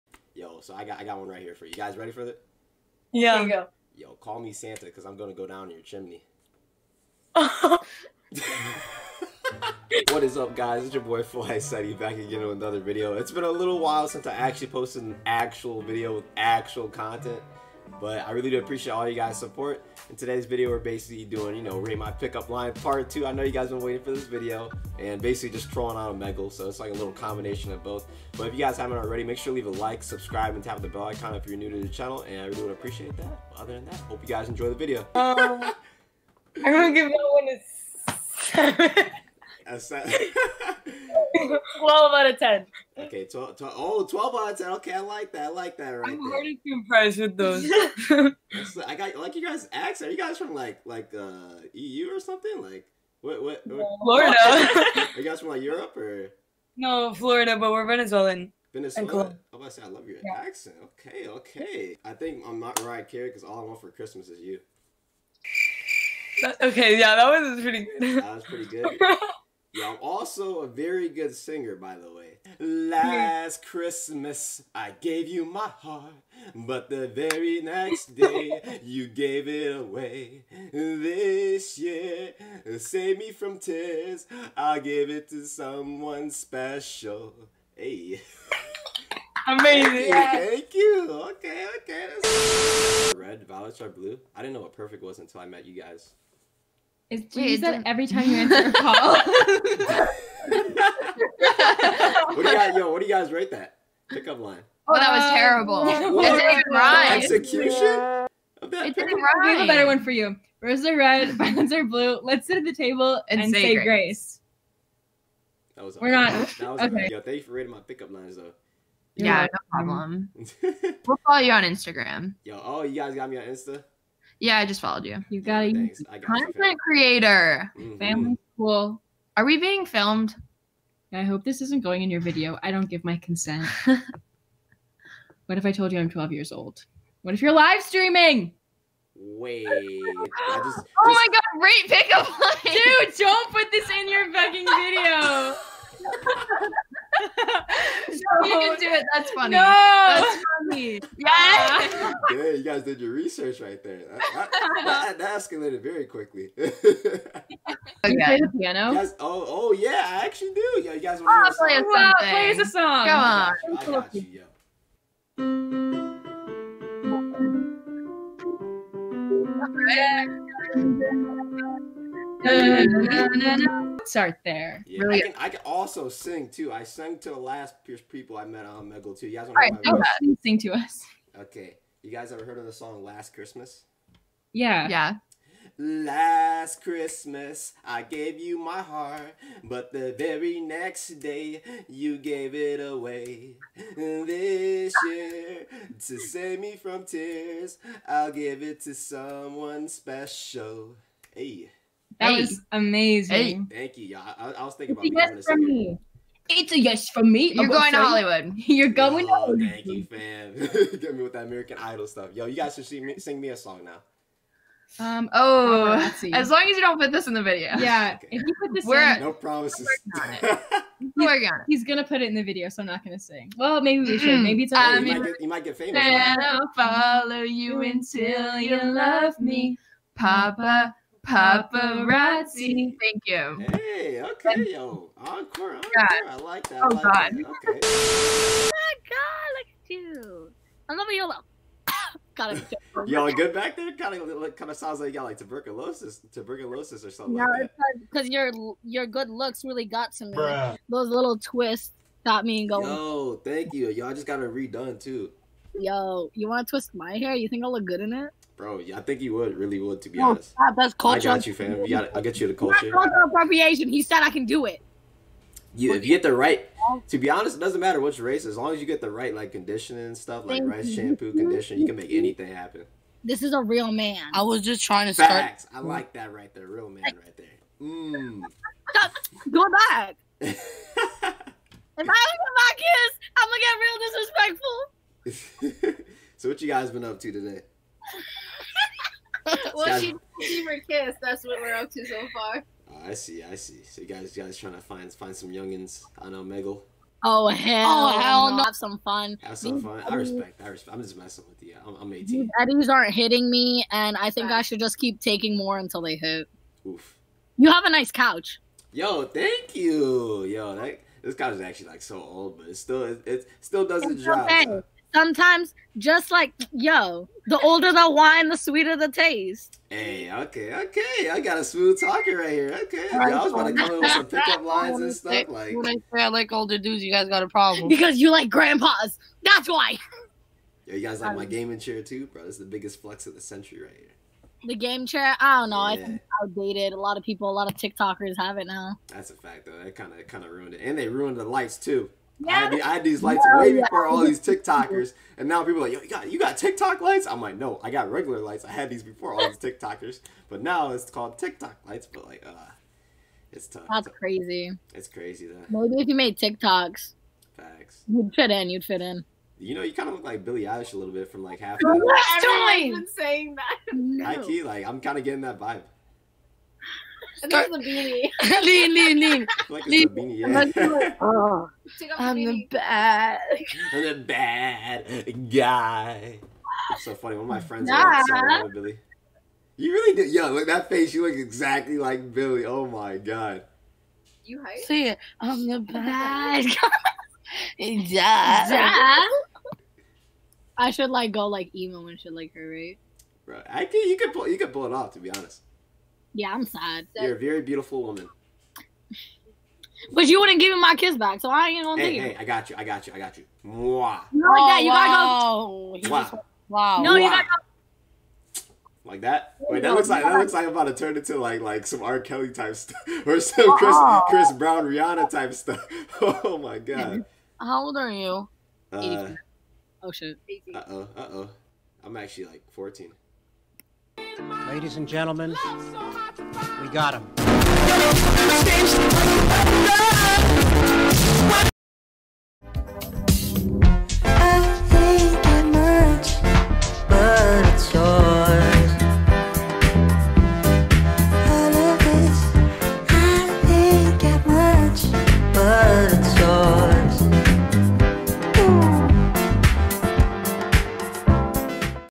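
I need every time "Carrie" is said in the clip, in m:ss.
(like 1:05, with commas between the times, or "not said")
1:03.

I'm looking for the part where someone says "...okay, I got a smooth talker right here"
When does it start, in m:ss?
5:20.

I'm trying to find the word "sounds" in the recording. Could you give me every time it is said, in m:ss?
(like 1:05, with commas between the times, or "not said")
4:04.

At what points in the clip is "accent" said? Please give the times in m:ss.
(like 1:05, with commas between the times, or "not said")
0:49, 1:00.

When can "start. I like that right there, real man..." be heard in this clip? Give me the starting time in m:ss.
4:35.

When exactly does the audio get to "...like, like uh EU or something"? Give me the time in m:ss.
0:50.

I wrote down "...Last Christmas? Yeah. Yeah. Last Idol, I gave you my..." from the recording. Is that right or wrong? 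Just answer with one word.
wrong.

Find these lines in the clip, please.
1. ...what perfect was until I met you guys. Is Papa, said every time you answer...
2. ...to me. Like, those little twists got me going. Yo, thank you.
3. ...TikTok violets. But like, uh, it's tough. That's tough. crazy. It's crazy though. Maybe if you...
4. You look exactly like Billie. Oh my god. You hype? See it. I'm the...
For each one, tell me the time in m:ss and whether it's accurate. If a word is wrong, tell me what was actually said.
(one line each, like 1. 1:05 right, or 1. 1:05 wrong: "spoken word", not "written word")
1. 1:34 wrong: "Wait", not "Papa"
2. 4:10 right
3. 5:51 wrong: "lights", not "violets"
4. 6:21 right.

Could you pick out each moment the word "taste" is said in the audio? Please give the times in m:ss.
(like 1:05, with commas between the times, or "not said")
5:19.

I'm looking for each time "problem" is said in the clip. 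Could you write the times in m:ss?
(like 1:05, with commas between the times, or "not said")
1:59, 5:27.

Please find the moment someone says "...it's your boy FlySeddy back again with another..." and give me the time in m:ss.
0:10.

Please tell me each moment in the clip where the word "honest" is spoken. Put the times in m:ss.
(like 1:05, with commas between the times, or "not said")
4:20, 4:27, 6:35.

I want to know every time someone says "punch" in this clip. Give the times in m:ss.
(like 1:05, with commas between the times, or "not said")
not said.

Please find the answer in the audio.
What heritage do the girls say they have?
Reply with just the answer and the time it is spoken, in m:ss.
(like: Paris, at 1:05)
Venezuelan, at 0:57.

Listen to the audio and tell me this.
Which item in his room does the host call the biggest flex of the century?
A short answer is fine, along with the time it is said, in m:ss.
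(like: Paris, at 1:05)
gaming chair, at 5:31.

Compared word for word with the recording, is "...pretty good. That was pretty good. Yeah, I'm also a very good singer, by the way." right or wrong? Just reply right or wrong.
right.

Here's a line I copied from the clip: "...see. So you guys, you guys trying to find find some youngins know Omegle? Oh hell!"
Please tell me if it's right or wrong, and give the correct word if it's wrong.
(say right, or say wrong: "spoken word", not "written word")
right.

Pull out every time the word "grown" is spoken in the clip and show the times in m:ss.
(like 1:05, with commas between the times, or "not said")
not said.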